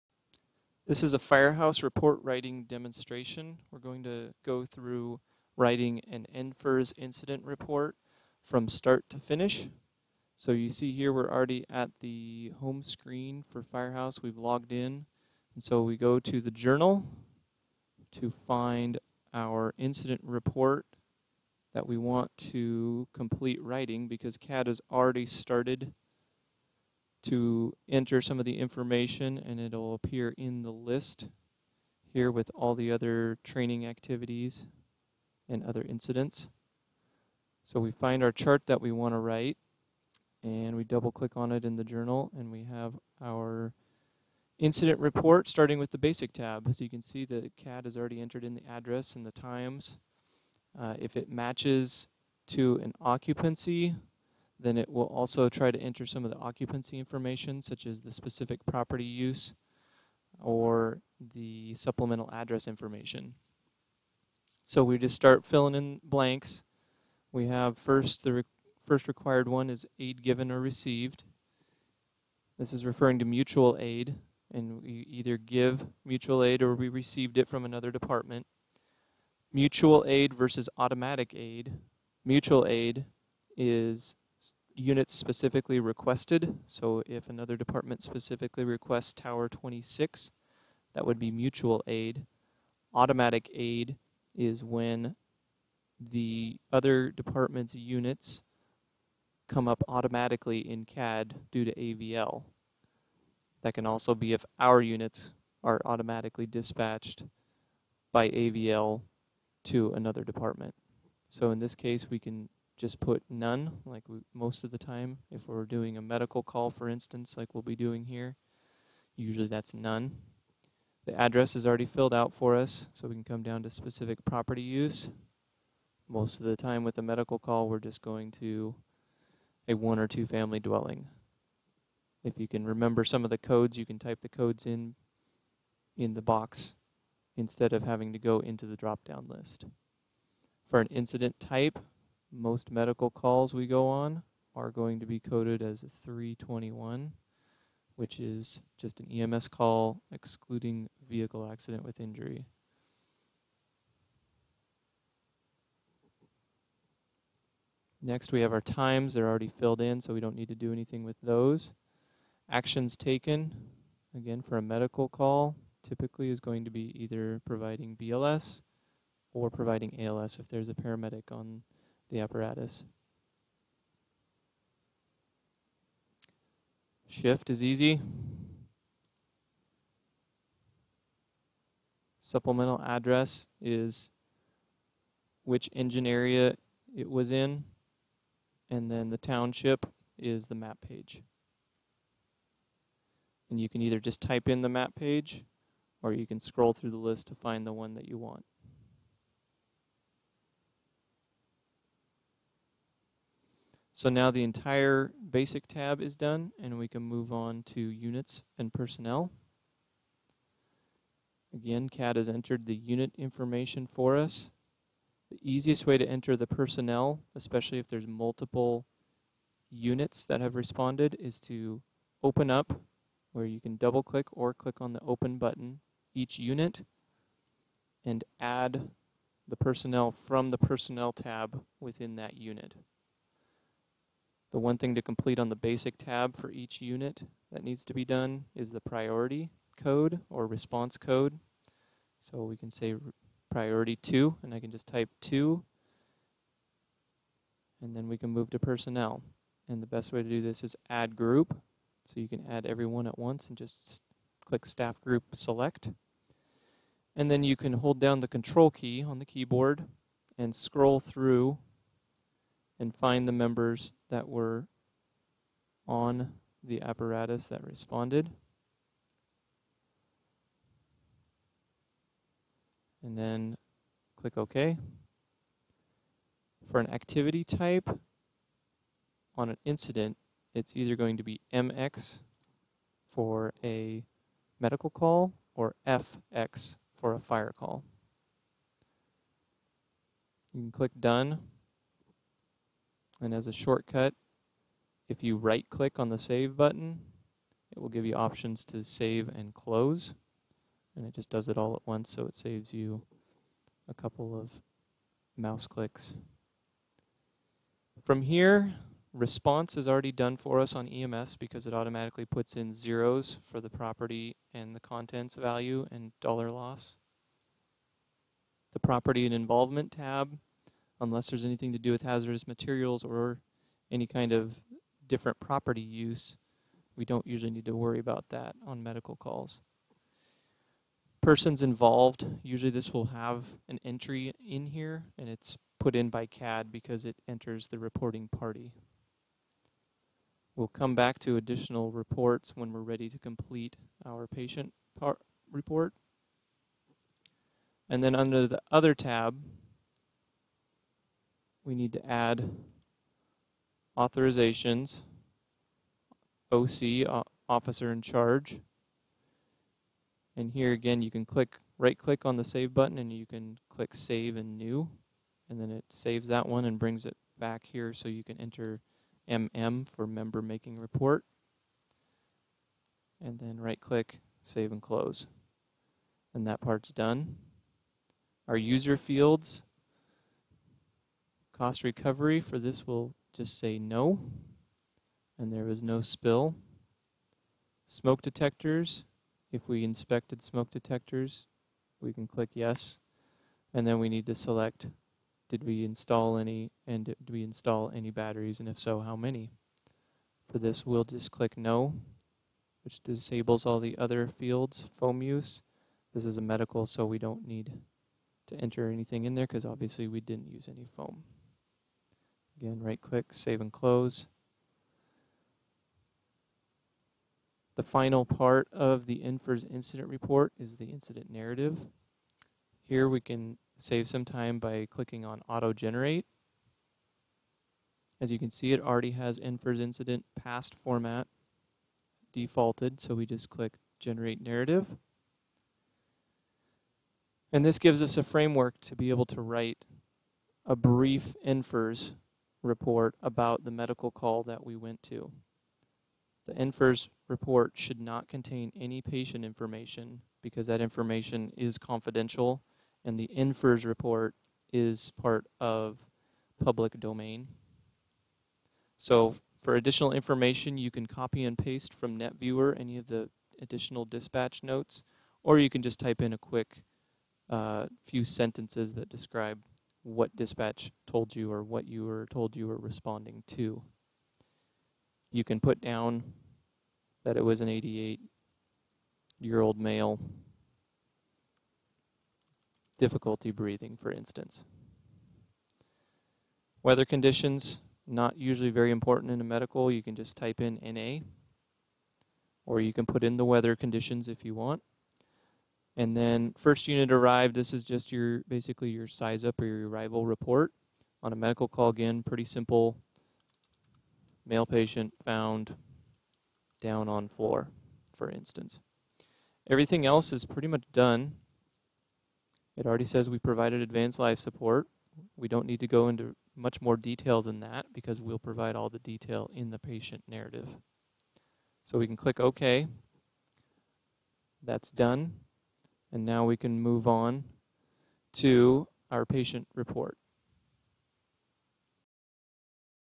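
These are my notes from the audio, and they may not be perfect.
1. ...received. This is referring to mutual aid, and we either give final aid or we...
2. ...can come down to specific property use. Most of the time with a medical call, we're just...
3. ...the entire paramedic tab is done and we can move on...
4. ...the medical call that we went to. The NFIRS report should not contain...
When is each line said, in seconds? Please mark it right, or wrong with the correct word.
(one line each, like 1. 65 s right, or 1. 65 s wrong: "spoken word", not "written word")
1. 70 s wrong: "mutual", not "final"
2. 123 s right
3. 204 s wrong: "basic", not "paramedic"
4. 443 s right.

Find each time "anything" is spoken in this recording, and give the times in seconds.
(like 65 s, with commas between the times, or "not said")
160 s, 321 s, 408 s.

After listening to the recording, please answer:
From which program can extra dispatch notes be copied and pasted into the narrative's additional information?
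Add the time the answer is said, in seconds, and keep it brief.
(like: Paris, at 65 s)
NetViewer, at 462 s.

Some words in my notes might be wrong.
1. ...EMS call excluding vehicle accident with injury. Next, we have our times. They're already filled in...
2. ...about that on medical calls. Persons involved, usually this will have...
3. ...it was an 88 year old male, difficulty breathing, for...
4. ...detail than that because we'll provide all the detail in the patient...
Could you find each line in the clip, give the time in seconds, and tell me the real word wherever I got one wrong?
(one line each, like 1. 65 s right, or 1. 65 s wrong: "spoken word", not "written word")
1. 149 s right
2. 327 s right
3. 477 s right
4. 516 s right.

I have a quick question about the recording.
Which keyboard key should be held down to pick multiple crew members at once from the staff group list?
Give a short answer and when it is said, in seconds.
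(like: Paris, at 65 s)
control key, at 258 s.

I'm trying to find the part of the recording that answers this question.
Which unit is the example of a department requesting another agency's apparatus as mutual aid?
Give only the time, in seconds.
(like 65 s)
89 s.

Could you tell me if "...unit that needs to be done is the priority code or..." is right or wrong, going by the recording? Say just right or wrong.
right.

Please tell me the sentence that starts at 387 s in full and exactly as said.
Smoke detectors, if we inspected smoke detectors, we can click yes.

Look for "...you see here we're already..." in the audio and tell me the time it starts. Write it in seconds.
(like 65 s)
10 s.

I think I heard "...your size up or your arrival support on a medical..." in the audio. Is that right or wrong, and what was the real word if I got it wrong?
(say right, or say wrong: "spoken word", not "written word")
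wrong: "report", not "support".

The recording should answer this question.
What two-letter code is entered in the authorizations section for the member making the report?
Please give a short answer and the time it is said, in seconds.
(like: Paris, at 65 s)
MM, at 369 s.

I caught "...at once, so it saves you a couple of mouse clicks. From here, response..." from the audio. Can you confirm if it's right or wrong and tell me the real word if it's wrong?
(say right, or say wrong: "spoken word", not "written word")
right.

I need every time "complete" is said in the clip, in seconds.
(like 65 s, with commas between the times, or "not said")
23 s, 235 s, 343 s.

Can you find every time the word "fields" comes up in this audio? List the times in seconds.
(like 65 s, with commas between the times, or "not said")
378 s, 404 s.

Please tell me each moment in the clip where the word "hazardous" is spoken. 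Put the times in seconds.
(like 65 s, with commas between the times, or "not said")
322 s.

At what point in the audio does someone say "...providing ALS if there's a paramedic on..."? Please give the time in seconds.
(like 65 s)
169 s.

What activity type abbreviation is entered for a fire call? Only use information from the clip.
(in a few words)
FX.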